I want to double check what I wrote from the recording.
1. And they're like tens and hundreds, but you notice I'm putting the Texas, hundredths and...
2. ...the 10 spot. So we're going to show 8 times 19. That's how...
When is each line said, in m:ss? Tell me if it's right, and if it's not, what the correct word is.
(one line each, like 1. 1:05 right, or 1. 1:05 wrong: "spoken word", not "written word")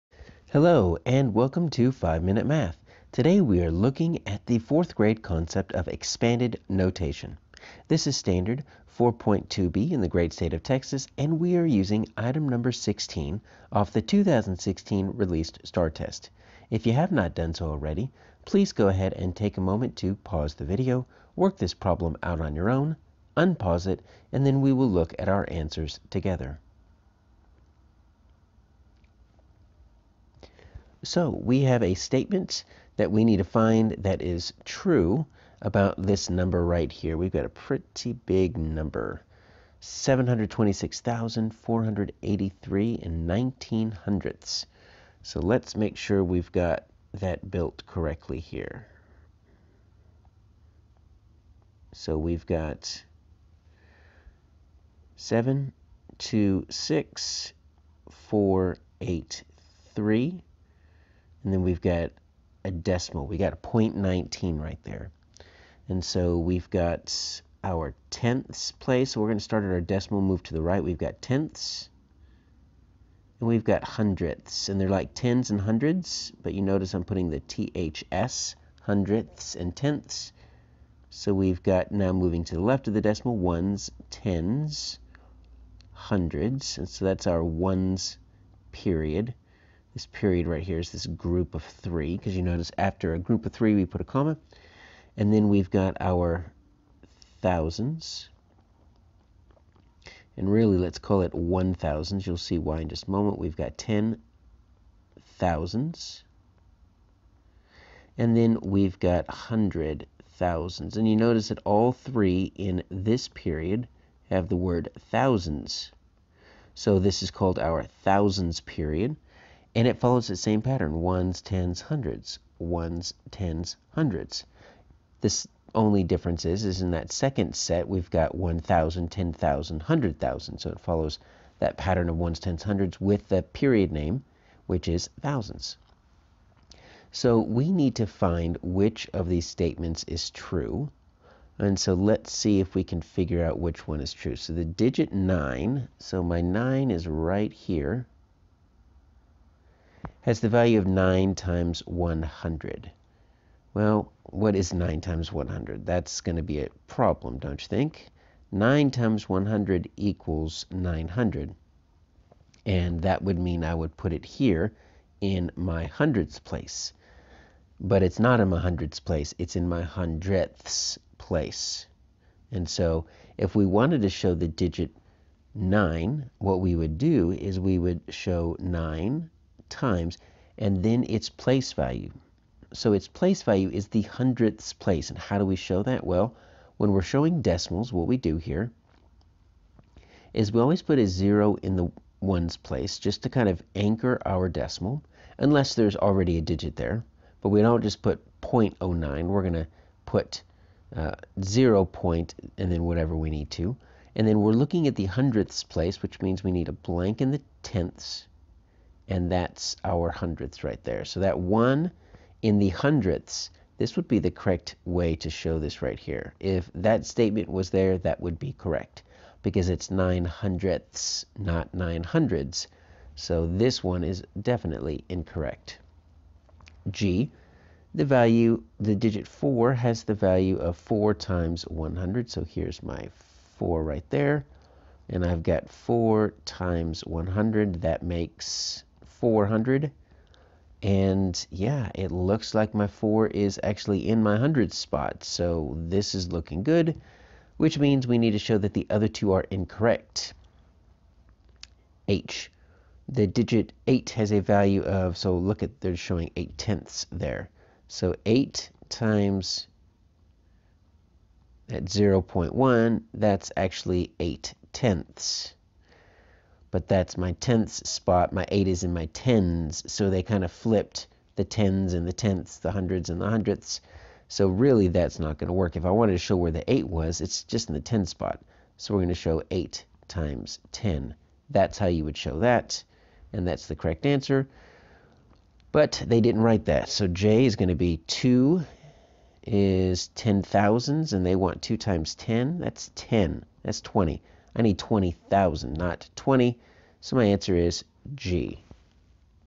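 1. 1:14 wrong: "THS", not "Texas"
2. 4:37 wrong: "10", not "19".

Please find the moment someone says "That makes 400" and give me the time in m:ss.
3:57.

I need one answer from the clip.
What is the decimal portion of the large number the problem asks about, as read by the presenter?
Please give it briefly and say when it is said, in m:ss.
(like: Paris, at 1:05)
0.19, at 1:03.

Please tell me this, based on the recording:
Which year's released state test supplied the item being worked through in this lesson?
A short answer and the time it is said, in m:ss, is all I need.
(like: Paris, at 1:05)
2016, at 0:14.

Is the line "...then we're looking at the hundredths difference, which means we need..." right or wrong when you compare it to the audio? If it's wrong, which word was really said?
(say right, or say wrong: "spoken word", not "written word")
wrong: "place", not "difference".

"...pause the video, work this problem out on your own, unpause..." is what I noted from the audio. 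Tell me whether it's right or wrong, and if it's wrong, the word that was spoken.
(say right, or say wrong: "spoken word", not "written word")
right.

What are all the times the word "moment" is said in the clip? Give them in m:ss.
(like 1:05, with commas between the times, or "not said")
0:19, 1:43.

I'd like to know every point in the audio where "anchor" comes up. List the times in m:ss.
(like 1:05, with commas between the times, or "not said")
3:13.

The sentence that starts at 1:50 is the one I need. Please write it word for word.
And you notice that all three in this period have the word thousands.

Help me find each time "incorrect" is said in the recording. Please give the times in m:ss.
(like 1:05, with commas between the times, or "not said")
3:45, 4:09.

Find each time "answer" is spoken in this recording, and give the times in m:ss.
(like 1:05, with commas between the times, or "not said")
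0:25, 4:44, 4:57.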